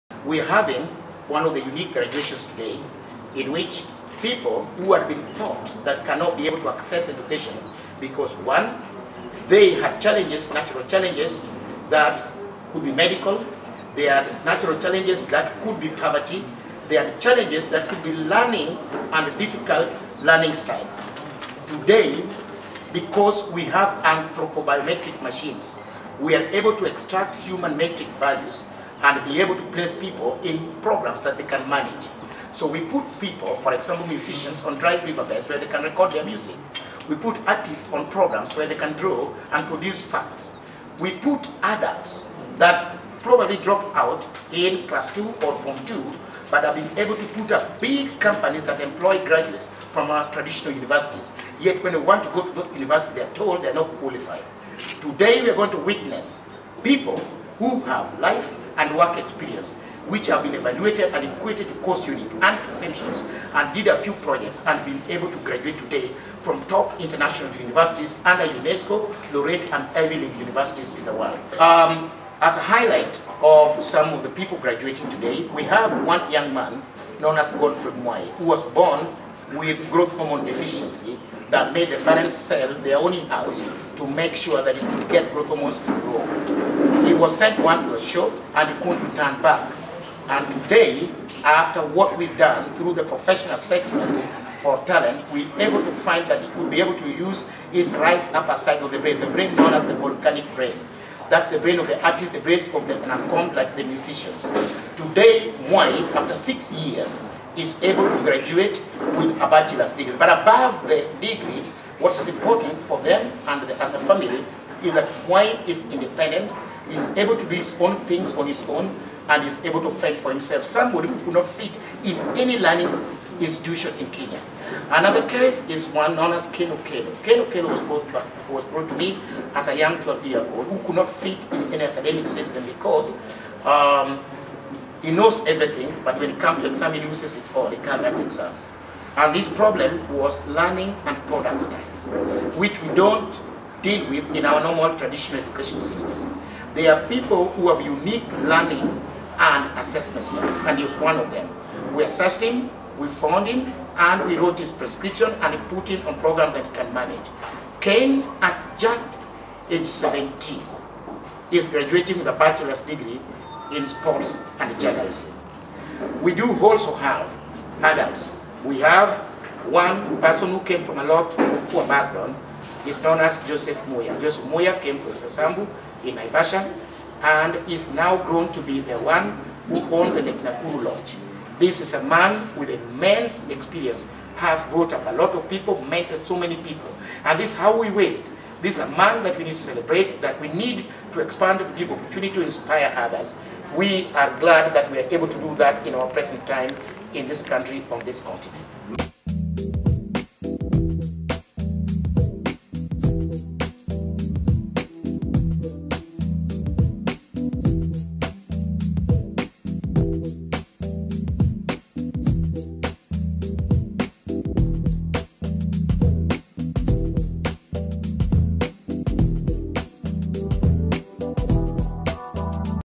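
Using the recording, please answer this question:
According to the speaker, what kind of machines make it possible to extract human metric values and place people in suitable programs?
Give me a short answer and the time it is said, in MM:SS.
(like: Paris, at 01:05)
anthropobiometric machines, at 00:24.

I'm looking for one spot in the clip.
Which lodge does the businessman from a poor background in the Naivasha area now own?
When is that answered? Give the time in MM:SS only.
03:00.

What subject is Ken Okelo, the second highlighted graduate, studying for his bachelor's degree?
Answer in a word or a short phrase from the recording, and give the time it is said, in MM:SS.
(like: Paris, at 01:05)
sports and journalism, at 02:43.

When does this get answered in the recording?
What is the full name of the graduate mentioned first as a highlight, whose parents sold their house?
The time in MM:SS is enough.
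01:17.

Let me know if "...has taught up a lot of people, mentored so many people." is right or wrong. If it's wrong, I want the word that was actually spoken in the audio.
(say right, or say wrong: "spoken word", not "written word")
wrong: "brought", not "taught".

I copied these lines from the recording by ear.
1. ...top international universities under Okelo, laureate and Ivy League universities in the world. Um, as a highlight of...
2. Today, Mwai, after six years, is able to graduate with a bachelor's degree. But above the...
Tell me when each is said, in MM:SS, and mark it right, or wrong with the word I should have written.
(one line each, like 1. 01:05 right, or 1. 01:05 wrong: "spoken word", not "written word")
1. 01:06 wrong: "UNESCO", not "Okelo"
2. 01:44 right.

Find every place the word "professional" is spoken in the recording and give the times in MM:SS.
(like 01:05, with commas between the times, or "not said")
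01:33.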